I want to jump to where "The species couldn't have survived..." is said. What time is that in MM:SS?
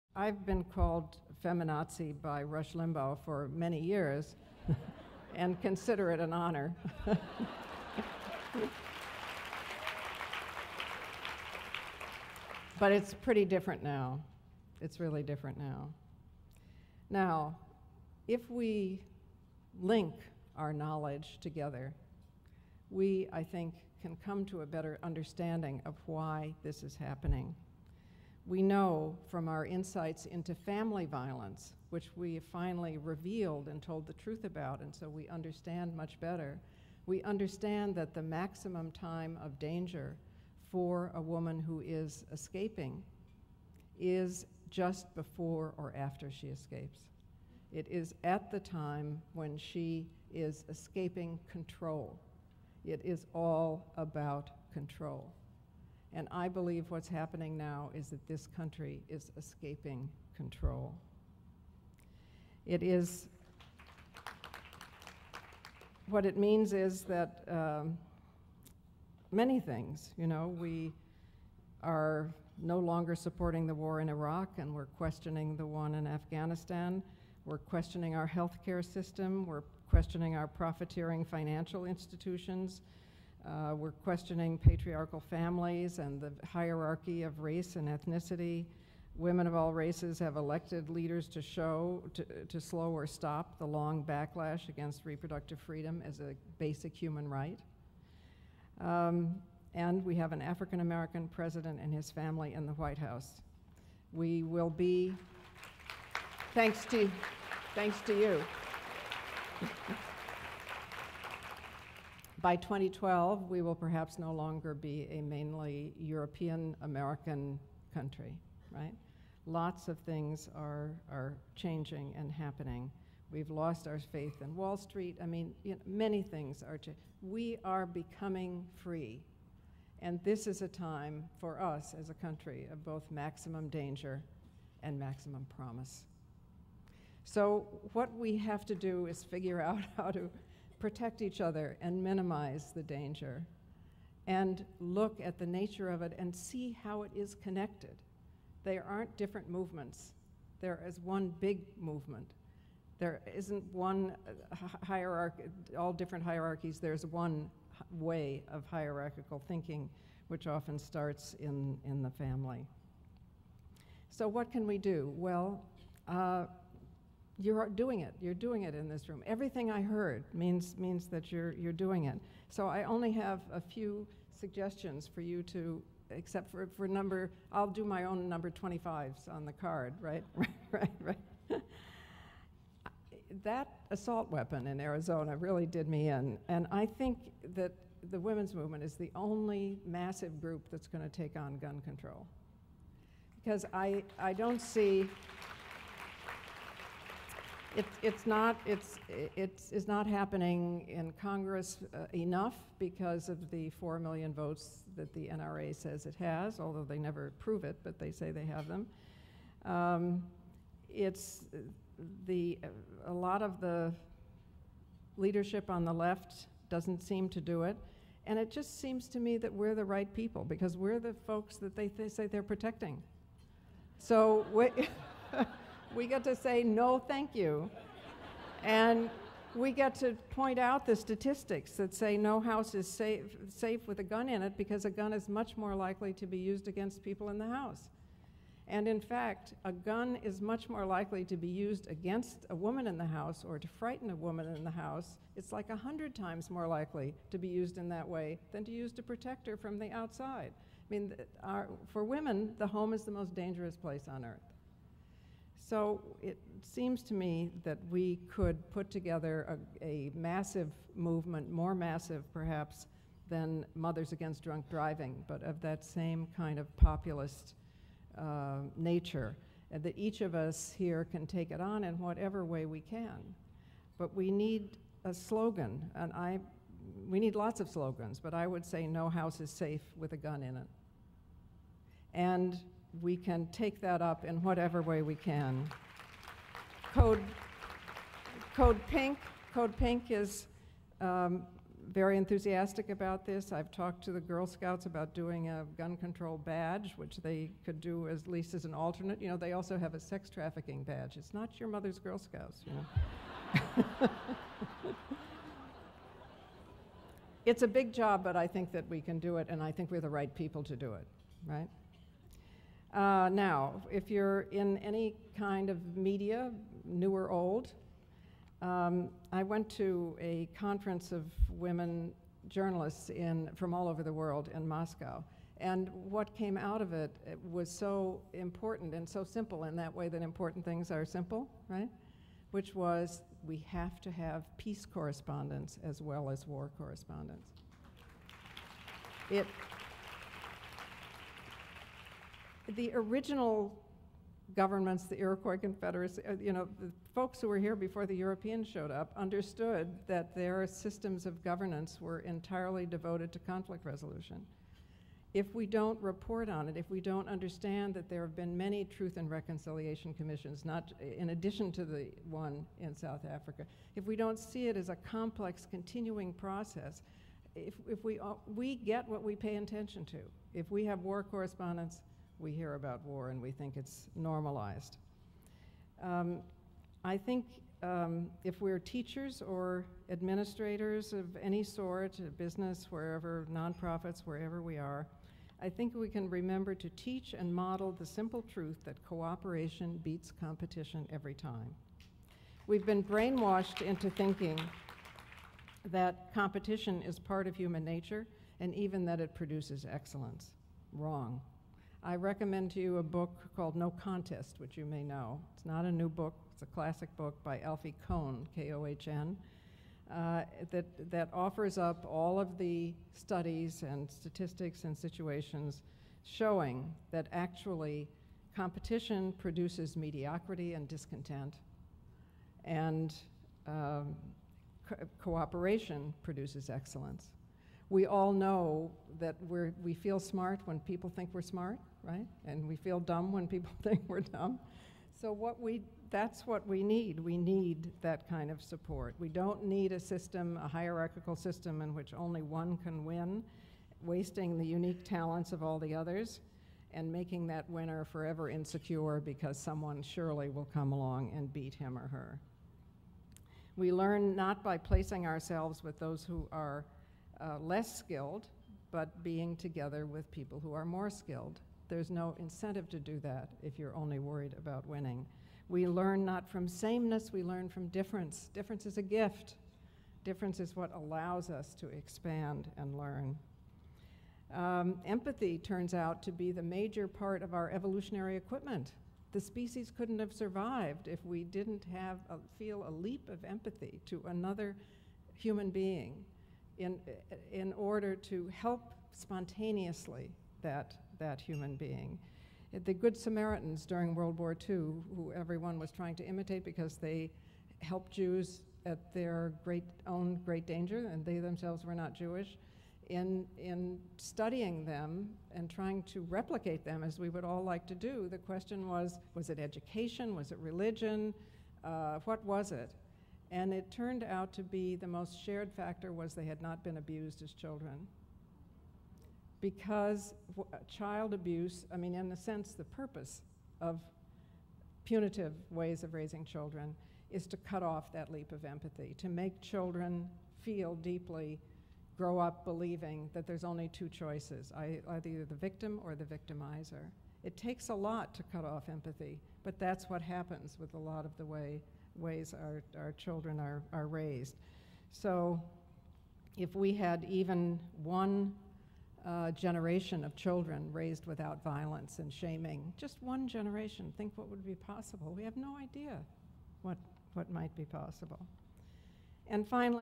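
07:59.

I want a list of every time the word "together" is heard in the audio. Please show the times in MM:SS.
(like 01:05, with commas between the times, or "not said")
00:21, 04:18, 07:39.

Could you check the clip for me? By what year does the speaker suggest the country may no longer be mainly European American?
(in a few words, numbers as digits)
2012.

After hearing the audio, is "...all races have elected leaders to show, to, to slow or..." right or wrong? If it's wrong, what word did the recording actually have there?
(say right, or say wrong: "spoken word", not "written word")
right.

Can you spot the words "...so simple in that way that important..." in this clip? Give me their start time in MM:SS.
05:29.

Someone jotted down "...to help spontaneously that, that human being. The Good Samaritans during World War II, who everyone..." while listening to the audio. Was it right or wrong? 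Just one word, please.
right.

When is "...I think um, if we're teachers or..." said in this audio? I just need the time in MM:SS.
06:17.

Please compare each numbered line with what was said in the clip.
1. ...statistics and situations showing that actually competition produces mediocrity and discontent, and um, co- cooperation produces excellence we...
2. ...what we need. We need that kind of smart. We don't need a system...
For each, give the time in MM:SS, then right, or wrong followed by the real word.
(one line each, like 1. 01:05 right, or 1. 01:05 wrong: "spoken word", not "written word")
1. 06:54 right
2. 07:16 wrong: "support", not "smart".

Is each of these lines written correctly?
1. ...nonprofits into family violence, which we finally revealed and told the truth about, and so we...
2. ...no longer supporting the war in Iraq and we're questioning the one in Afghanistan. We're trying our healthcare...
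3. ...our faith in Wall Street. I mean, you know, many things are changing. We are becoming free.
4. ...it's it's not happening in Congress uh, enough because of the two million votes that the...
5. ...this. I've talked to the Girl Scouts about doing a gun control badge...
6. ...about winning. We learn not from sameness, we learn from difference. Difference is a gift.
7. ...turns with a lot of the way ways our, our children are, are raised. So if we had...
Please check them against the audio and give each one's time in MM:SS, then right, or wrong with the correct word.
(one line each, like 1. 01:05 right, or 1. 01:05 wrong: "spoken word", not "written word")
1. 00:29 wrong: "insights", not "nonprofits"
2. 01:12 wrong: "questioning", not "trying"
3. 02:03 right
4. 03:18 wrong: "four", not "two"
5. 04:53 right
6. 07:44 right
7. 09:00 wrong: "happens", not "turns".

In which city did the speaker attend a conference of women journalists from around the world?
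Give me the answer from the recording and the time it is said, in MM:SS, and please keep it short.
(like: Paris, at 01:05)
Moscow, at 05:24.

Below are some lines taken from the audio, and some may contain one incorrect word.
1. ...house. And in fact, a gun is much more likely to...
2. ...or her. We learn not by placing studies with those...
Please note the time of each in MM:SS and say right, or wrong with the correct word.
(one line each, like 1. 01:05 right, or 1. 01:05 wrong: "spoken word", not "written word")
1. 03:57 right
2. 07:31 wrong: "ourselves", not "studies".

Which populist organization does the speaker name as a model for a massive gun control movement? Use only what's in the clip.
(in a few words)
Mothers Against Drunk Driving.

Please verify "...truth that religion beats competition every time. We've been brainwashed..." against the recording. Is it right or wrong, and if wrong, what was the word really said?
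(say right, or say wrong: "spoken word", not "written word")
wrong: "cooperation", not "religion".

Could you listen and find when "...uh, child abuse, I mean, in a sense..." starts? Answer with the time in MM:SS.
08:40.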